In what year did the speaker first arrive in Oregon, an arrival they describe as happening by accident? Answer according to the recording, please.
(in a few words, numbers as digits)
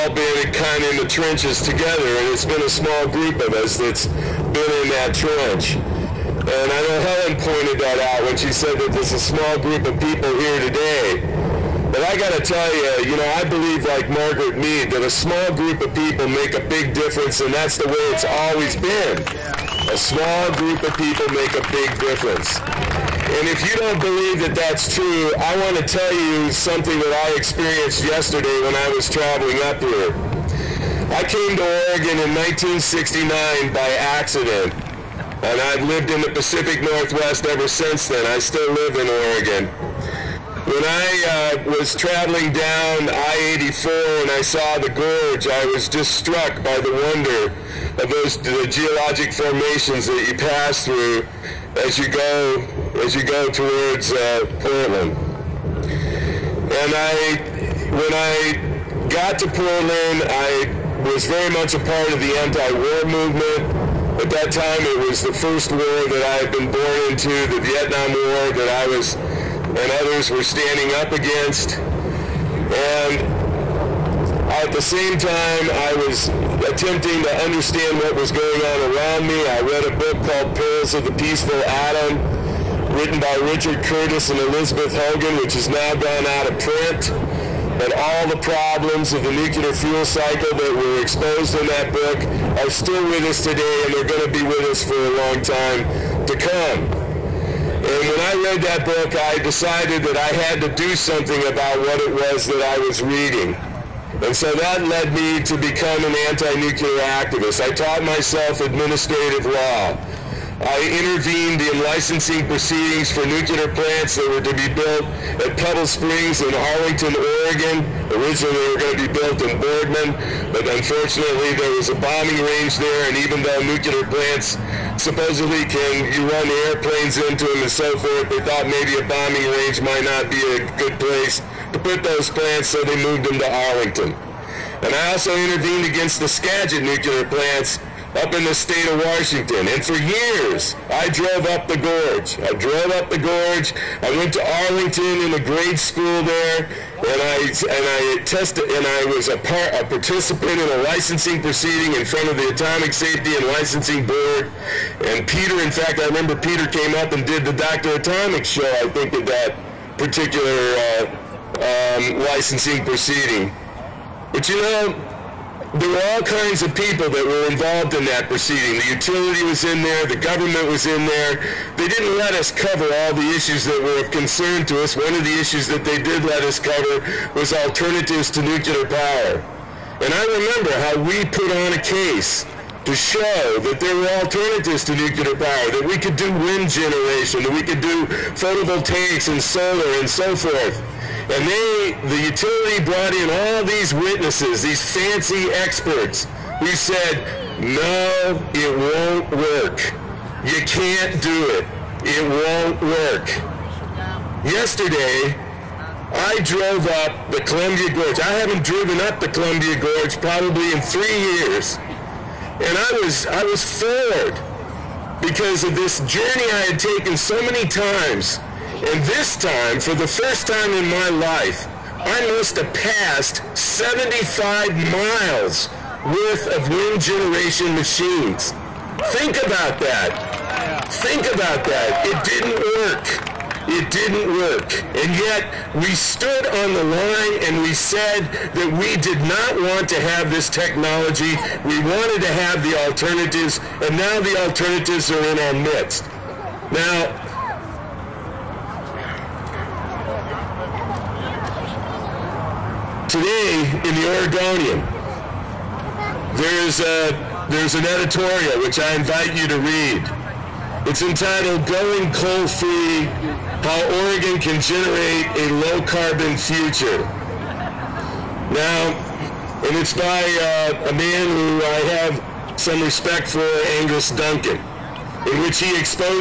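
1969.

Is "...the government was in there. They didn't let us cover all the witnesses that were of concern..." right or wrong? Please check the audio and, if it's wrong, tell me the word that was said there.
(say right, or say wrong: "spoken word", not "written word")
wrong: "issues", not "witnesses".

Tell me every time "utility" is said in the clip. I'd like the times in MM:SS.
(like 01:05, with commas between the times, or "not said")
02:48, 03:12.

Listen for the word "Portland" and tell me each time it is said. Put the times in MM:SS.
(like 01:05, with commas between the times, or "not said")
00:54, 00:59.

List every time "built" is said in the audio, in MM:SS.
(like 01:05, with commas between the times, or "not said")
01:54, 01:59.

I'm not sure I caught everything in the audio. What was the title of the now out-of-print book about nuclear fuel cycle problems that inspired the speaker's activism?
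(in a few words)
Perils of the Peaceful Atom.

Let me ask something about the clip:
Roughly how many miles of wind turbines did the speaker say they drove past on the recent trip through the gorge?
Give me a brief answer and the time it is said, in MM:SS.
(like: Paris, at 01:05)
75, at 03:43.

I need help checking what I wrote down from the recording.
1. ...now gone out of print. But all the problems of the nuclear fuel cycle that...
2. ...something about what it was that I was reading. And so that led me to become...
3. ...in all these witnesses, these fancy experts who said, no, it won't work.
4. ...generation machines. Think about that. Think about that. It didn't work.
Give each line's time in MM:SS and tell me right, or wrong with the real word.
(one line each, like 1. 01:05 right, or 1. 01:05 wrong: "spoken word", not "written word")
1. 01:25 right
2. 01:40 right
3. 03:13 right
4. 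03:47 right.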